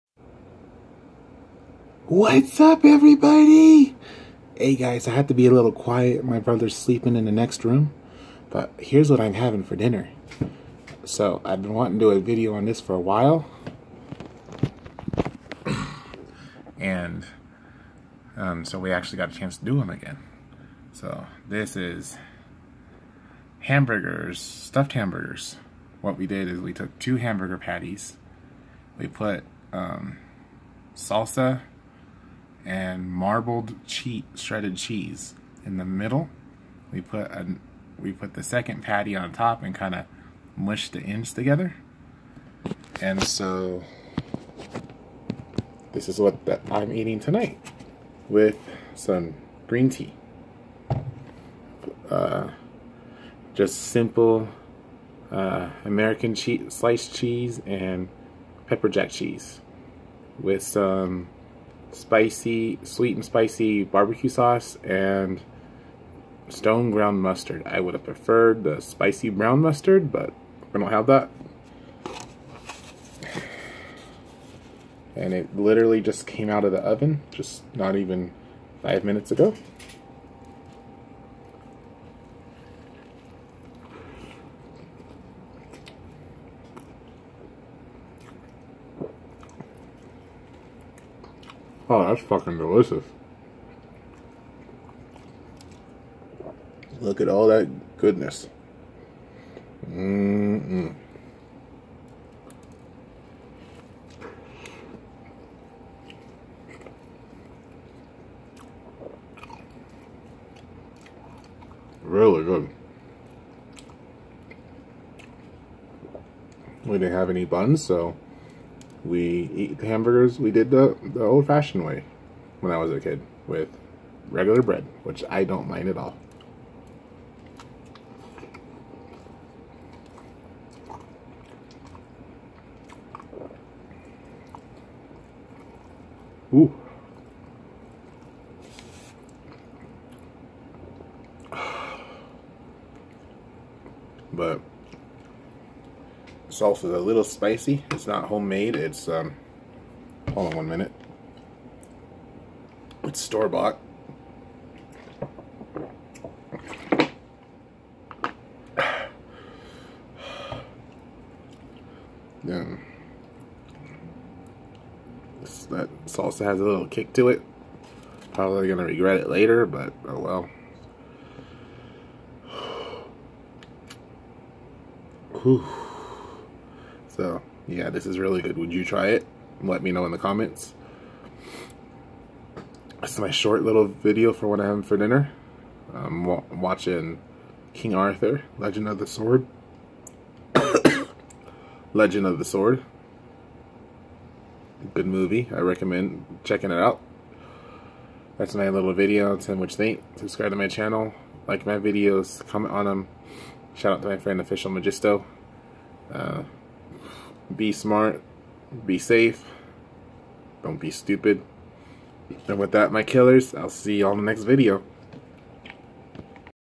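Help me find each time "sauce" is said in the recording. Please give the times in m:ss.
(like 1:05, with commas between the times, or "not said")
1:04, 2:26.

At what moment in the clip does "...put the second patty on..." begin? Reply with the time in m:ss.
0:38.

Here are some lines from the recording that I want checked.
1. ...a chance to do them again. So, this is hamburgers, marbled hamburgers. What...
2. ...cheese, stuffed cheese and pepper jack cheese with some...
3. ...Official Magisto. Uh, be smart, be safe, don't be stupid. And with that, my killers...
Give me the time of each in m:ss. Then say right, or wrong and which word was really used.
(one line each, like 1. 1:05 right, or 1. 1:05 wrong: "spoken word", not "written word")
1. 0:19 wrong: "stuffed", not "marbled"
2. 0:56 wrong: "sliced", not "stuffed"
3. 3:24 right.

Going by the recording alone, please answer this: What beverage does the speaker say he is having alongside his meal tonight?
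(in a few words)
Green tea.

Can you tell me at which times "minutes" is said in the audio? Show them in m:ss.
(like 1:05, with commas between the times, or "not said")
1:19, 2:30.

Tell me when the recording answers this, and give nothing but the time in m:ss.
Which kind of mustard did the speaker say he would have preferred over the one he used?
1:08.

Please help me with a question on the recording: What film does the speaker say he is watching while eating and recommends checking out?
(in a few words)
King Arthur: Legend of the Sword.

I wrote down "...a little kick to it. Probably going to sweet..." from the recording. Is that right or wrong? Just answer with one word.
wrong.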